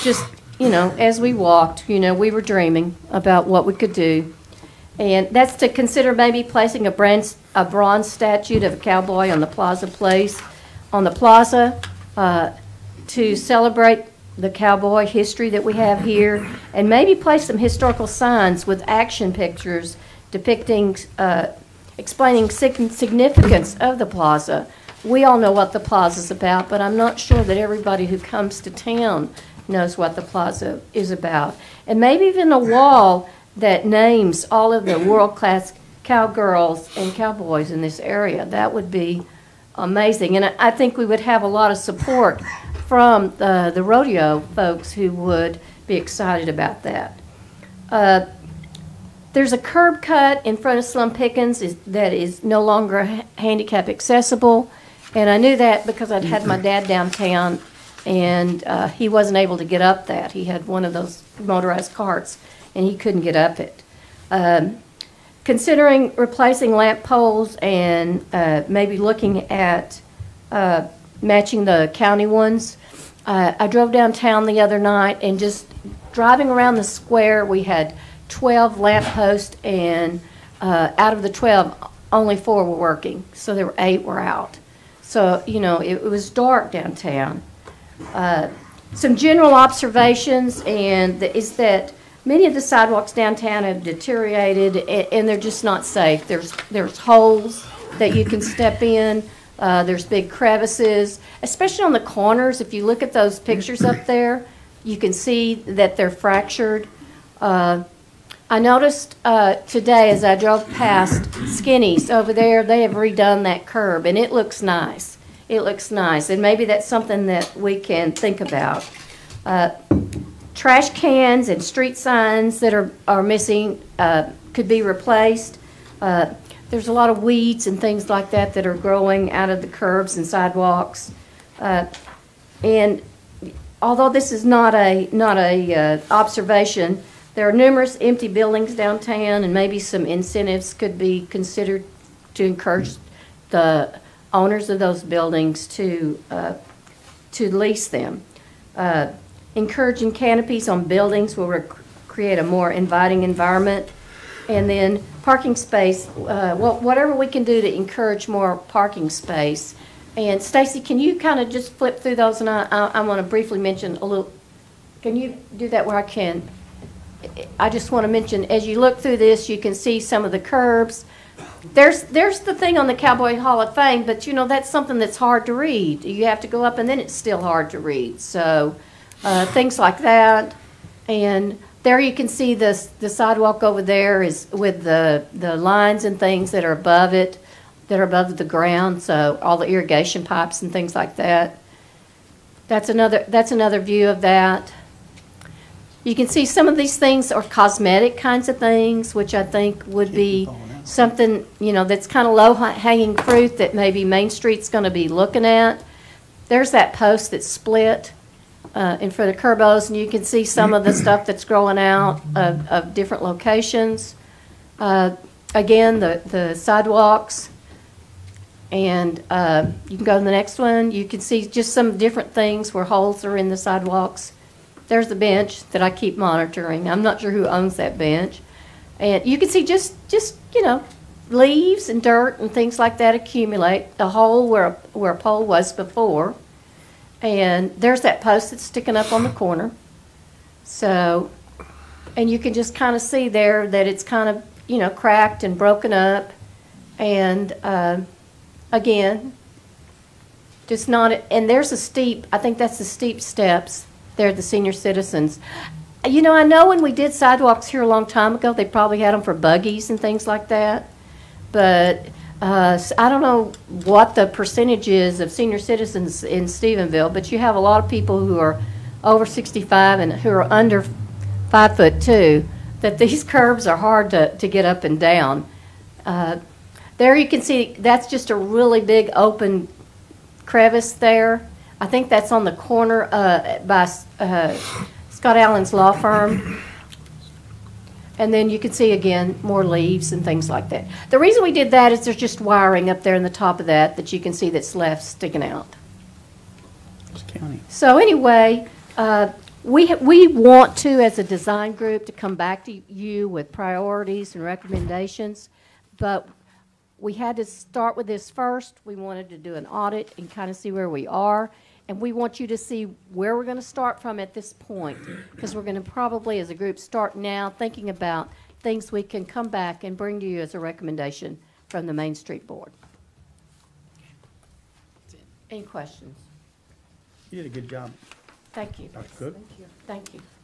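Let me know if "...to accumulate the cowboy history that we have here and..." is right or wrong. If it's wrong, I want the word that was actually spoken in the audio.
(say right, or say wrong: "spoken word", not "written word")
wrong: "celebrate", not "accumulate".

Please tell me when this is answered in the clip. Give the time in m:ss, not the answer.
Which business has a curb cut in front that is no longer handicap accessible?
0:50.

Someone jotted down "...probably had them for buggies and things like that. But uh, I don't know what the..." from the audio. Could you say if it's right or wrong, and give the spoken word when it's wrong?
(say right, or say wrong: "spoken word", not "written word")
right.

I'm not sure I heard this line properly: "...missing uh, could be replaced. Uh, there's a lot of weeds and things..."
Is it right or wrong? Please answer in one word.
right.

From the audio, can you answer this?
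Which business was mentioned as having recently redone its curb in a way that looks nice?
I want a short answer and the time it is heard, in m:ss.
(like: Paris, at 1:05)
Skinny's, at 1:51.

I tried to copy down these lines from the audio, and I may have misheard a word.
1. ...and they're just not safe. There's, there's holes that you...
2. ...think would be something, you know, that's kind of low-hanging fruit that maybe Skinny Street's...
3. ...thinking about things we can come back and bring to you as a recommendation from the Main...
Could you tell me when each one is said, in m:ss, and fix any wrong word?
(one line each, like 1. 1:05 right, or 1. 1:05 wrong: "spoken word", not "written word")
1. 1:35 right
2. 3:19 wrong: "Main", not "Skinny"
3. 5:17 right.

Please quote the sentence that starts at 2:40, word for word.
And Stacy, can you kind of just flip through those?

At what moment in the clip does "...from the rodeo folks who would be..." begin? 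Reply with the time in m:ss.
0:42.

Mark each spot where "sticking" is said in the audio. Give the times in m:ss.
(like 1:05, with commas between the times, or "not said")
3:58, 4:55.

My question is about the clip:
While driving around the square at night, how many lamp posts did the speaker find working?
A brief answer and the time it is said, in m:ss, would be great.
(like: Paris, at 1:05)
4, at 1:22.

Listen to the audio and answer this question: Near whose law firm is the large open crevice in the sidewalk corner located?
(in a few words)
Scott Allen.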